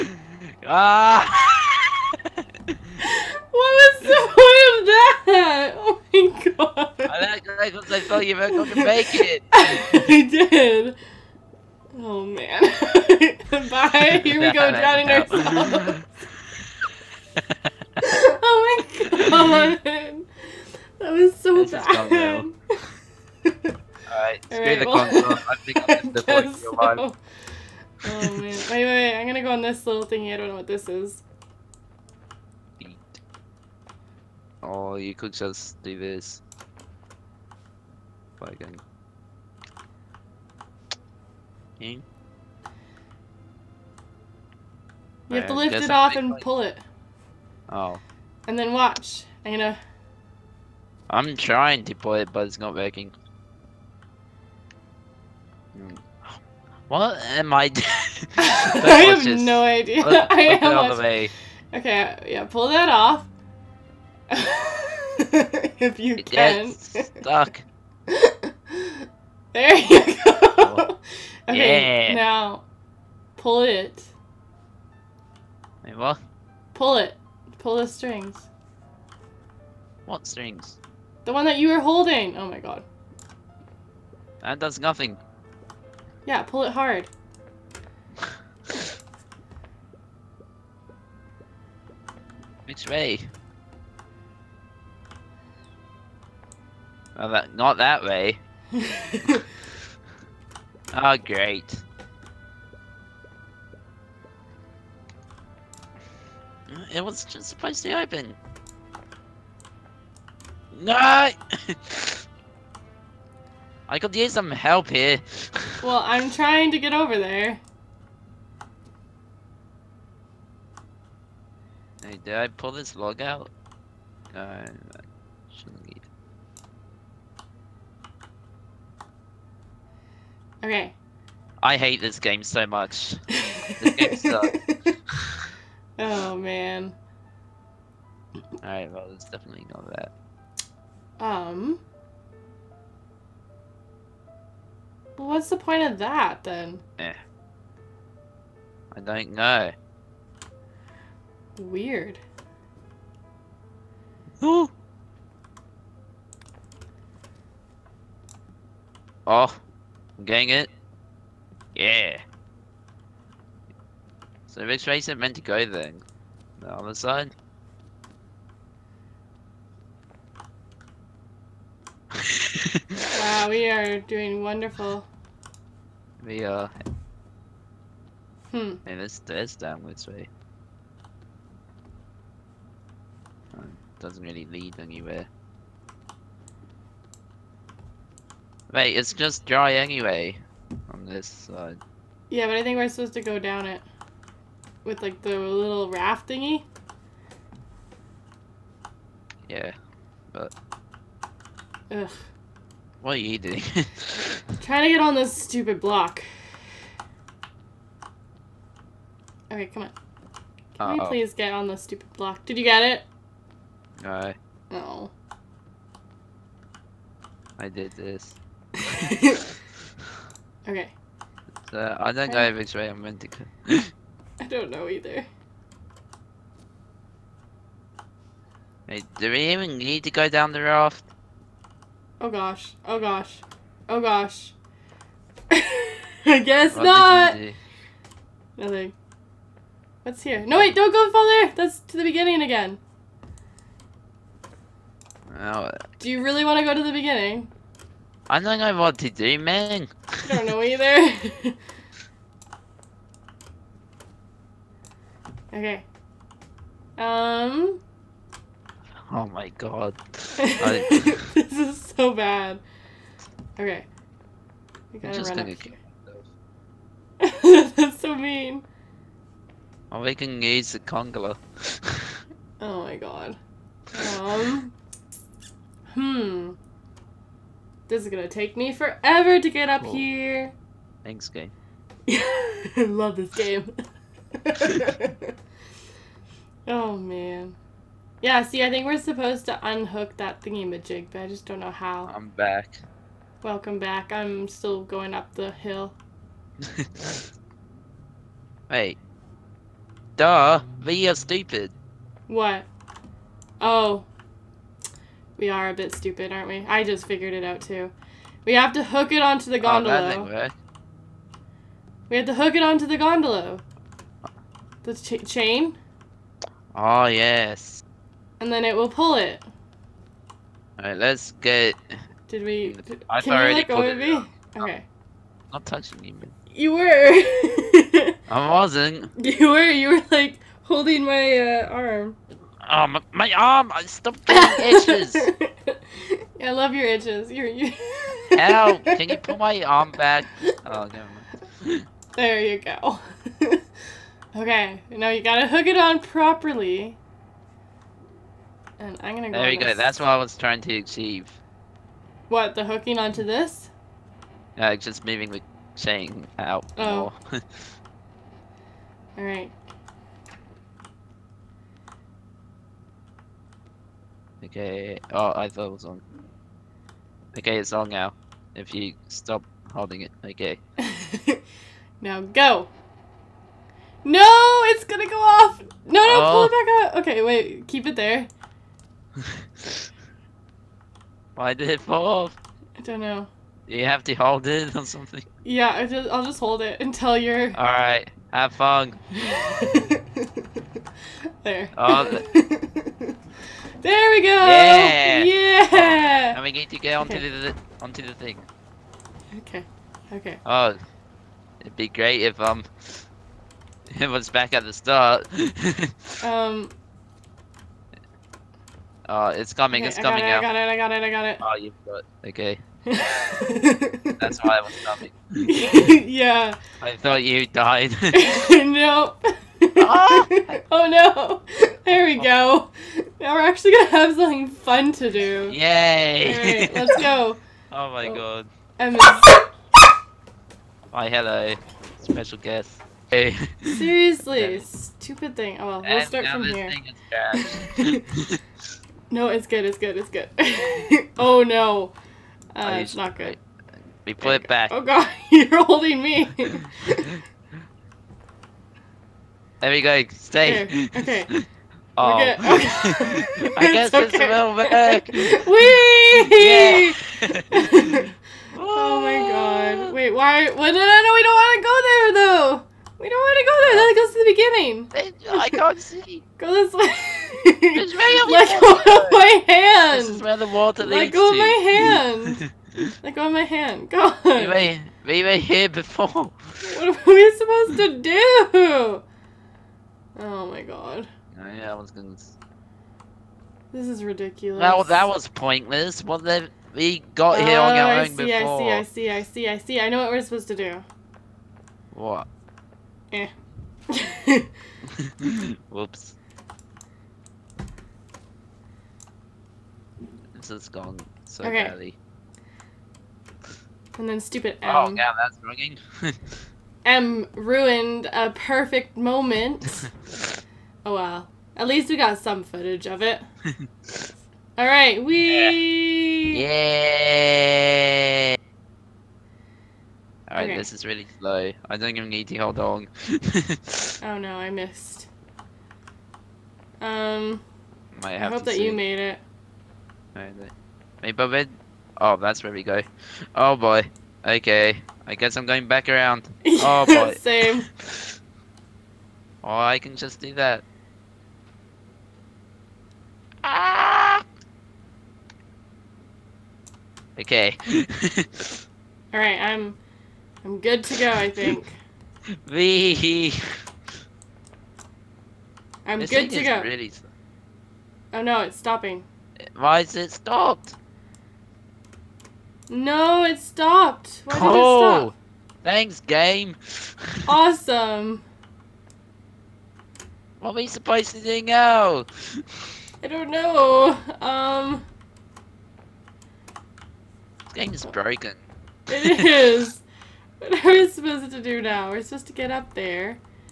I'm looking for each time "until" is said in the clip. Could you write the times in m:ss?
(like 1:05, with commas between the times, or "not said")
6:26.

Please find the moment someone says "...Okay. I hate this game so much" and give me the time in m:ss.
2:10.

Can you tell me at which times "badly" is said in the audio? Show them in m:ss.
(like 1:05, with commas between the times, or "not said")
8:21.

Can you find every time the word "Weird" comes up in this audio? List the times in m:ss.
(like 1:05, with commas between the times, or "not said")
2:31.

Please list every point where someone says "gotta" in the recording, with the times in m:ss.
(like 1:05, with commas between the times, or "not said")
4:25, 5:45.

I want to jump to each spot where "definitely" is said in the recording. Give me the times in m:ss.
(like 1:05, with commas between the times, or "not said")
2:19.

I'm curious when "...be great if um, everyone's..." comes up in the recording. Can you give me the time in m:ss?
6:41.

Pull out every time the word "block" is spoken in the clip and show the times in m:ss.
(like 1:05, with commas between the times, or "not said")
3:25, 3:32.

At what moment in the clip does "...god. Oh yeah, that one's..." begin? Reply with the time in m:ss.
8:00.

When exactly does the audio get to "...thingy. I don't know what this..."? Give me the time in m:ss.
0:30.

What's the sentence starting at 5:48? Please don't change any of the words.
And I'm gonna go There you go, that's what I was trying to achieve.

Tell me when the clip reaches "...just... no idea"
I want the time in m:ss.
0:59.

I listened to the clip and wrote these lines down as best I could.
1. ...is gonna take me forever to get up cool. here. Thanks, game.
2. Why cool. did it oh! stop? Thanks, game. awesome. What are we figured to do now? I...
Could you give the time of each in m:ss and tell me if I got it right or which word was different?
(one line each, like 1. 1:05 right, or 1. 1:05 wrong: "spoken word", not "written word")
1. 4:38 right
2. 9:24 wrong: "supposed", not "figured".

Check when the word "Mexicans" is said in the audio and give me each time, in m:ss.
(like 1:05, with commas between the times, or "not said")
not said.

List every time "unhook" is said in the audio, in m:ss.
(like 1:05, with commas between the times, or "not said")
4:49.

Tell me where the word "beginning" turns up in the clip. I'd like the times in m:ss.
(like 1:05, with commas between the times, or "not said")
4:02, 4:06, 7:44.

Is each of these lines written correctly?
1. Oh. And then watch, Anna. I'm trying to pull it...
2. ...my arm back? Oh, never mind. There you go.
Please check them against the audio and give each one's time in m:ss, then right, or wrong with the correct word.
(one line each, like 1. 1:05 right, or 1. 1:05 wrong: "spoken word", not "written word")
1. 0:47 right
2. 5:39 right.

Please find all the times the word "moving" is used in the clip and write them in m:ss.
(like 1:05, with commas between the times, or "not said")
5:55.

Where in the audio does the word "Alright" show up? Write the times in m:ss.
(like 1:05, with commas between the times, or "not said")
0:24, 2:18, 5:20, 5:59, 6:27, 7:06.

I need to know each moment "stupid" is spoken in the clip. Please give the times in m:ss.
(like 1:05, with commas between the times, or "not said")
3:25, 3:31, 5:01, 5:05, 7:14, 8:24.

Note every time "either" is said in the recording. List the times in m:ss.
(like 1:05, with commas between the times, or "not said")
3:44, 4:10.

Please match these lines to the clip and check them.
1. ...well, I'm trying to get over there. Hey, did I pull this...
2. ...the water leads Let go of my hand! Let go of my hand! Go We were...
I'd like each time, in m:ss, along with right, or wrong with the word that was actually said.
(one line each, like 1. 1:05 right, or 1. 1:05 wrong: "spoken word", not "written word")
1. 1:55 right
2. 7:50 right.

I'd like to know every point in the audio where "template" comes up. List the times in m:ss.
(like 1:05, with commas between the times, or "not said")
not said.